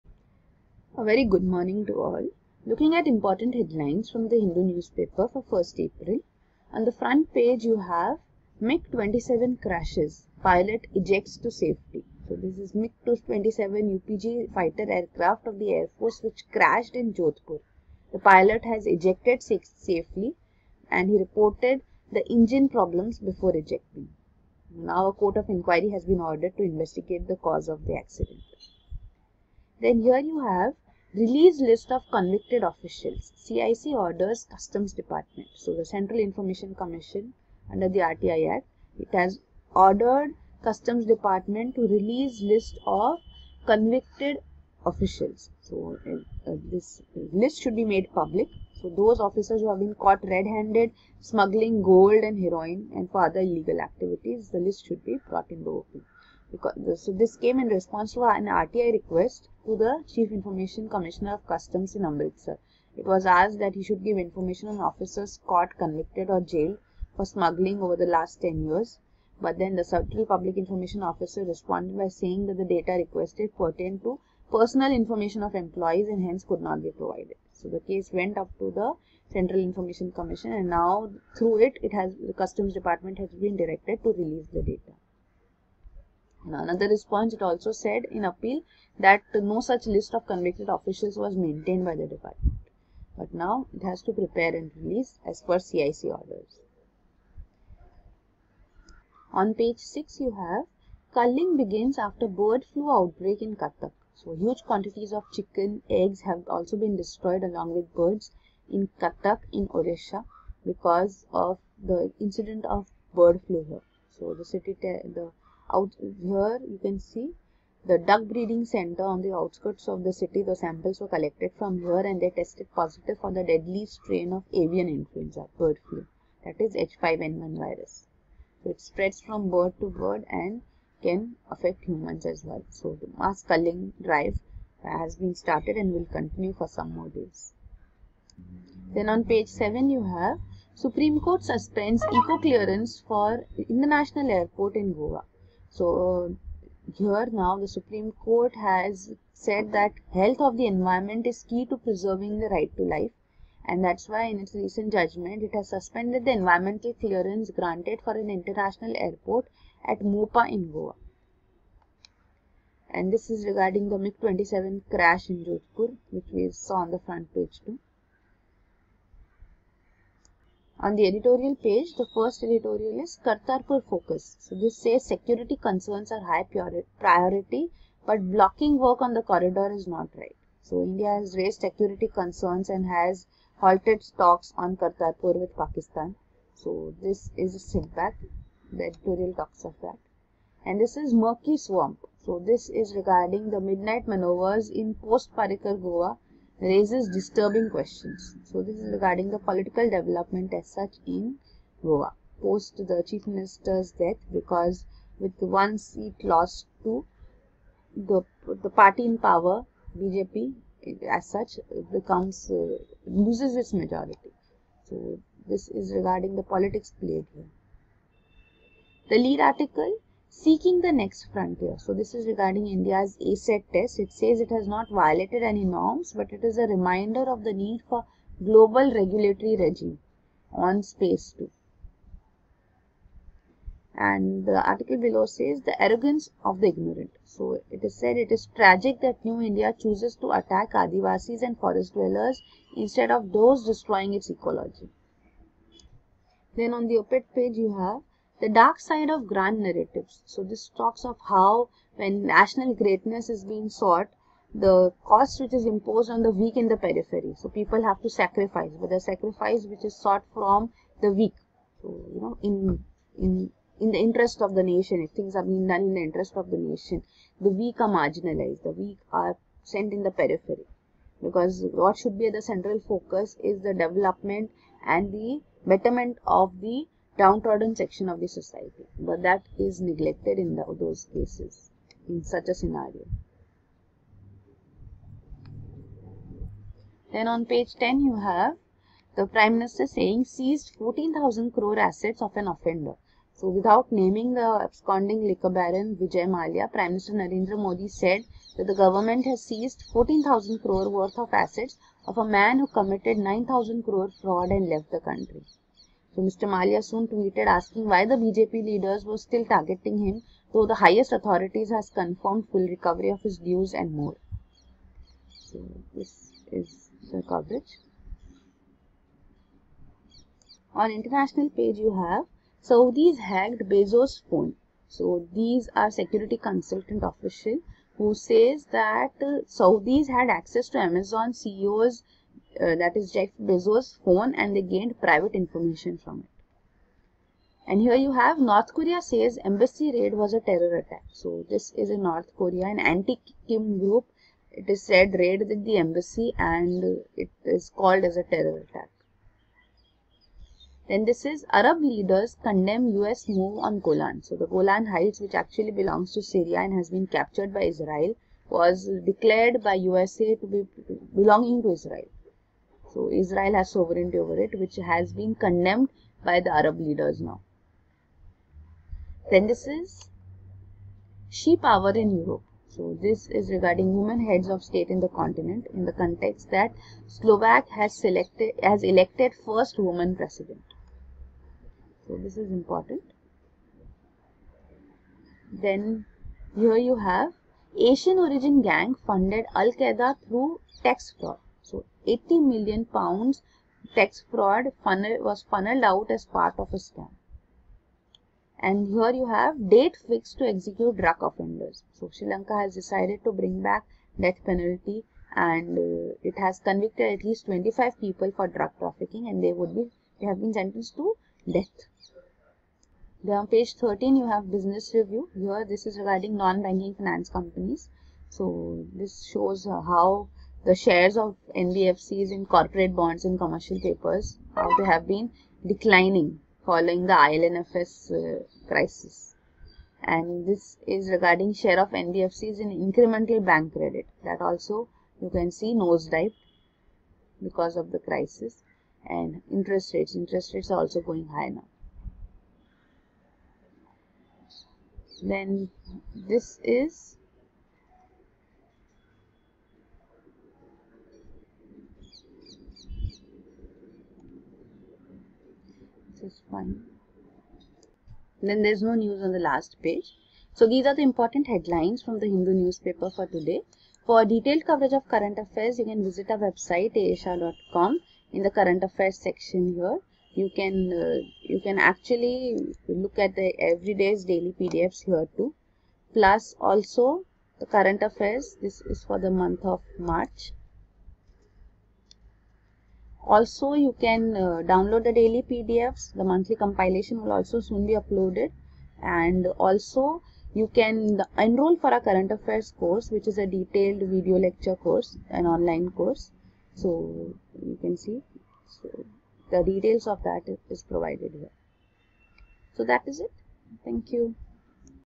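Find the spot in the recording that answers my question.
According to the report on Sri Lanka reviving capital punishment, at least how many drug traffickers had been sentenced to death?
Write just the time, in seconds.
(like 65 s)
407 s.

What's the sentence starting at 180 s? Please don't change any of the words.
So India has raised security concerns and has halted talks on Kartarpur with Pakistan.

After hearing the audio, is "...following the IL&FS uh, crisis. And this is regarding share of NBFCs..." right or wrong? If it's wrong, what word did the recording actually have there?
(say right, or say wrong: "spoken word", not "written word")
right.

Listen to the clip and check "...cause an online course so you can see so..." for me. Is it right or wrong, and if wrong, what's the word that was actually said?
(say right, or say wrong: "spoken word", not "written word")
wrong: "course", not "cause".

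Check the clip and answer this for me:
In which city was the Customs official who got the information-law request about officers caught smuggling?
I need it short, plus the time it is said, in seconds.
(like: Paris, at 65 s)
Amritsar, at 62 s.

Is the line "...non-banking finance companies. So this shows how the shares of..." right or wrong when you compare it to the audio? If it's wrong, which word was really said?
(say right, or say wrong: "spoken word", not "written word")
right.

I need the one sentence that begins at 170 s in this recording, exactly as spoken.
On the editorial page, the first editorial is Kartarpur Focus.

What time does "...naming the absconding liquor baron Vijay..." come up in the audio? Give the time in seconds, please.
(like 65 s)
293 s.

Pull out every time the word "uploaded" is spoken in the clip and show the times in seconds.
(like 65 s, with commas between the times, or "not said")
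487 s.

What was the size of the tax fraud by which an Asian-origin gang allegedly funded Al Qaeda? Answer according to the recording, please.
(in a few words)
80 million pounds.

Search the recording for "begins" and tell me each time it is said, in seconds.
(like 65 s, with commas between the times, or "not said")
101 s.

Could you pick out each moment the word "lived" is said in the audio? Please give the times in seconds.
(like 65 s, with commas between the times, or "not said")
not said.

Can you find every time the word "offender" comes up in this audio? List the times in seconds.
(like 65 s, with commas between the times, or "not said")
292 s, 401 s.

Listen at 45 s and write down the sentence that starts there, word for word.
So uh, uh, this list should be made public.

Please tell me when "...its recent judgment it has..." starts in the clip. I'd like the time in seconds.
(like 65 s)
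154 s.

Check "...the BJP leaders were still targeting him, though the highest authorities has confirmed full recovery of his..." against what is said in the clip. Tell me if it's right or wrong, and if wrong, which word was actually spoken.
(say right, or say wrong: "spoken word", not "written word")
right.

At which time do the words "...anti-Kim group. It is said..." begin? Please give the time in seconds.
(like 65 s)
342 s.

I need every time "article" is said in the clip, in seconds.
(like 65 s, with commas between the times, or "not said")
219 s, 234 s.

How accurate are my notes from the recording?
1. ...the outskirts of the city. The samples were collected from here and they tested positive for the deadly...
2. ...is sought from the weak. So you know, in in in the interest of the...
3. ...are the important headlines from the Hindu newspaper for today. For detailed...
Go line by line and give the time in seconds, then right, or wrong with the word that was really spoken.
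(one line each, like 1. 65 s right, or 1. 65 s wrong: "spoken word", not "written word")
1. 119 s right
2. 259 s right
3. 460 s right.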